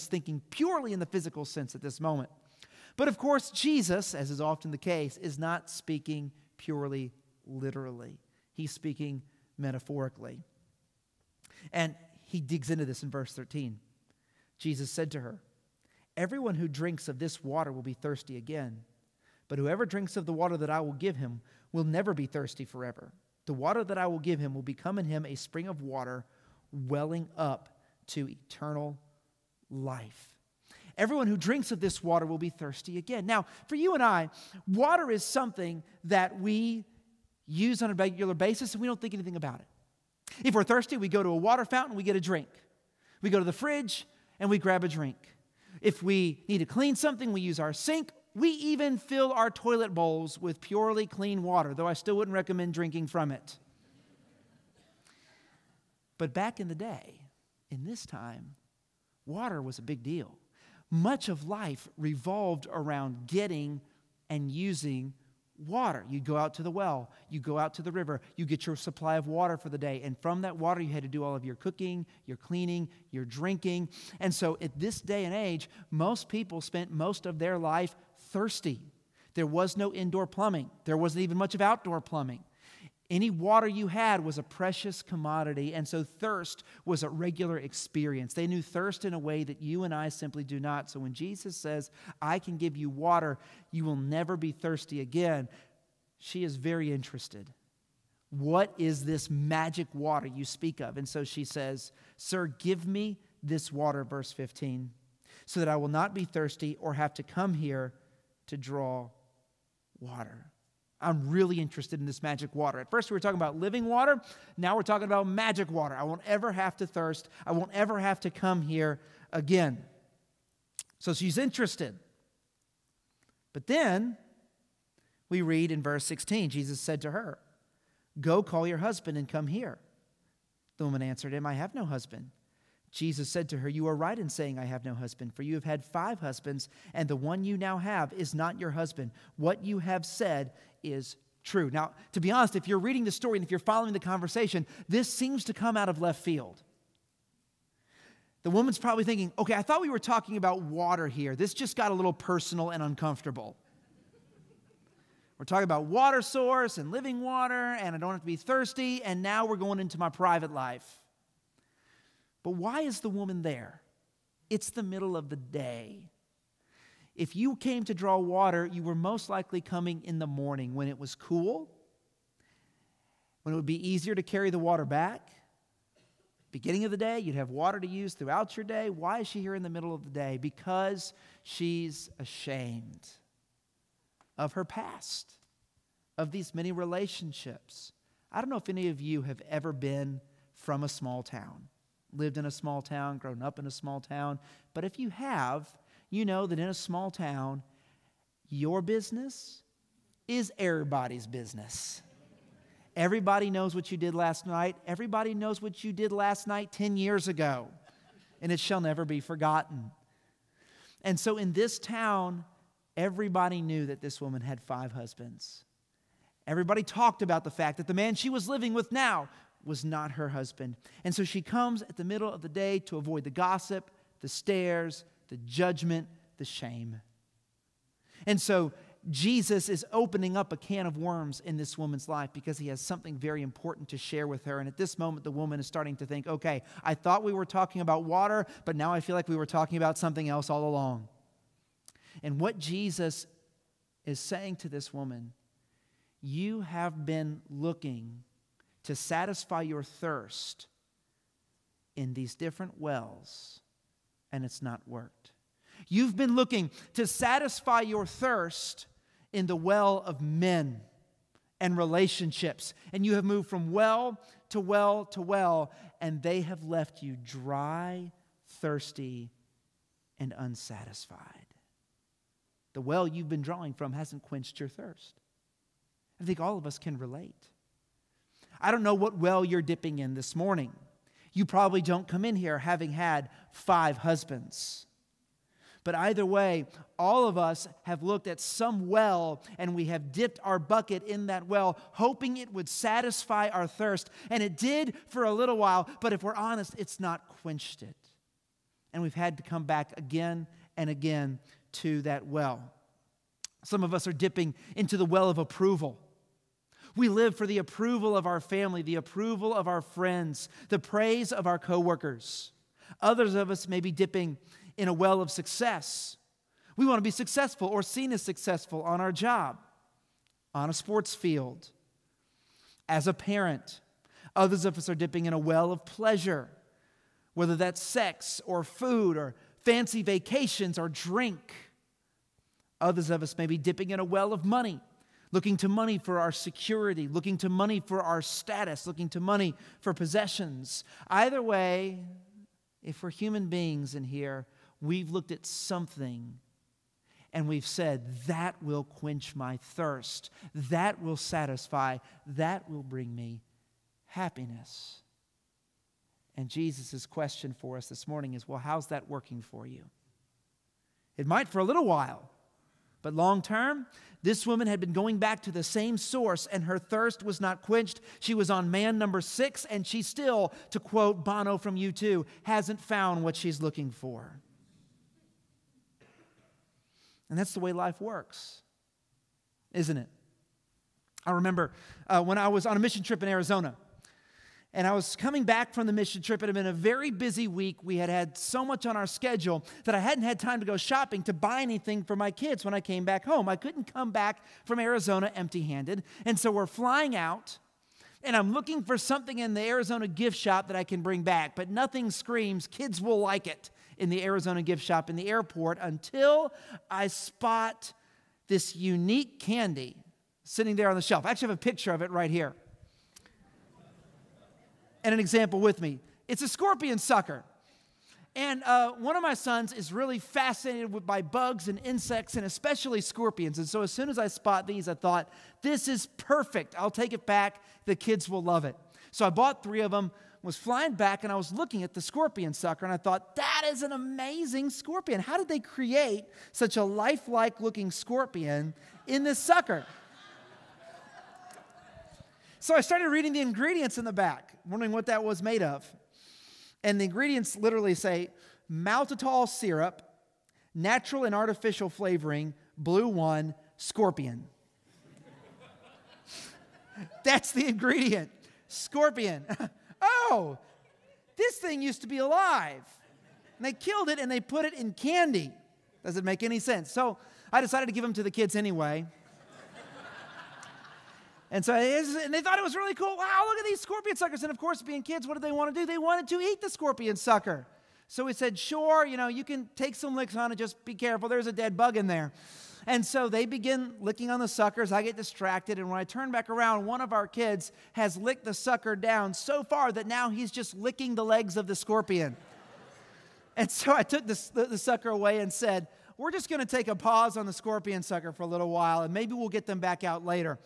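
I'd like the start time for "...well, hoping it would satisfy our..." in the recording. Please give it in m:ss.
4:51.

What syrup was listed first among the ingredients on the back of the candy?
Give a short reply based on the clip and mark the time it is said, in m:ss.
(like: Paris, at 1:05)
Maltitol syrup, at 7:28.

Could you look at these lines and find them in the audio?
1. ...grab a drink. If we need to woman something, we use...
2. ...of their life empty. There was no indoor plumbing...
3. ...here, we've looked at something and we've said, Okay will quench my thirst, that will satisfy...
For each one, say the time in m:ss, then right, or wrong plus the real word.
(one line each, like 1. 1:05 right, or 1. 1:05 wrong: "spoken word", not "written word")
1. 0:44 wrong: "clean", not "woman"
2. 1:17 wrong: "thirsty", not "empty"
3. 5:44 wrong: "That", not "Okay".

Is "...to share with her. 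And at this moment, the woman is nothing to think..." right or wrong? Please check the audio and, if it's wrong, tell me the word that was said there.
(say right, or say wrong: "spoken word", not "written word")
wrong: "starting", not "nothing".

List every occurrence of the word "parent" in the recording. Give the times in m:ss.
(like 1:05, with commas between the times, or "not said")
5:23.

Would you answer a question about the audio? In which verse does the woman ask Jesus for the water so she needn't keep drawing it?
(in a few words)
Verse 15.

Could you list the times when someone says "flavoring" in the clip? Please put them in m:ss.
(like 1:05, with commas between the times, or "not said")
7:31.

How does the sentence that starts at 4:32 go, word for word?
The well you've been drawing from hasn't quenched your thirst.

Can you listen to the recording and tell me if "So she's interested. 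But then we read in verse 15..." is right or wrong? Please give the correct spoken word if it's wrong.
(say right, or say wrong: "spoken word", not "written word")
wrong: "16", not "15".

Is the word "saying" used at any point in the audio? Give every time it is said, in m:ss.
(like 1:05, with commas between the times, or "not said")
2:14, 4:04.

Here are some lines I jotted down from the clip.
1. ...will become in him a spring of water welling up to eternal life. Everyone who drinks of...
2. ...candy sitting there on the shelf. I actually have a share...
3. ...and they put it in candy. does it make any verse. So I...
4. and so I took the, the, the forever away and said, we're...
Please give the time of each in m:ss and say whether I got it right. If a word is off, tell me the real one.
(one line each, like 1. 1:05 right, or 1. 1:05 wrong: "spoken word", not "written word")
1. 0:24 right
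2. 6:49 wrong: "picture", not "share"
3. 7:44 wrong: "sense", not "verse"
4. 8:13 wrong: "sucker", not "forever".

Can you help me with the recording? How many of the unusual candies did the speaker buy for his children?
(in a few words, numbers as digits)
3.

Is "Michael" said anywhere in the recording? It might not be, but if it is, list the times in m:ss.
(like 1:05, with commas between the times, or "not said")
not said.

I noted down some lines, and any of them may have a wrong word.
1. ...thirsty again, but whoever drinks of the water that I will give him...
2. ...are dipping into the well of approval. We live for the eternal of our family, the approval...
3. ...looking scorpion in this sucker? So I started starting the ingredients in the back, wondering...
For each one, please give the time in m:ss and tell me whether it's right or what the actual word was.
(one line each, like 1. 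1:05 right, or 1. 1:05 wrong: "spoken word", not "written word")
1. 0:17 right
2. 5:04 wrong: "approval", not "eternal"
3. 7:17 wrong: "reading", not "starting".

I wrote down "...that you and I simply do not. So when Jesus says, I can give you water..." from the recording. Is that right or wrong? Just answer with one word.
right.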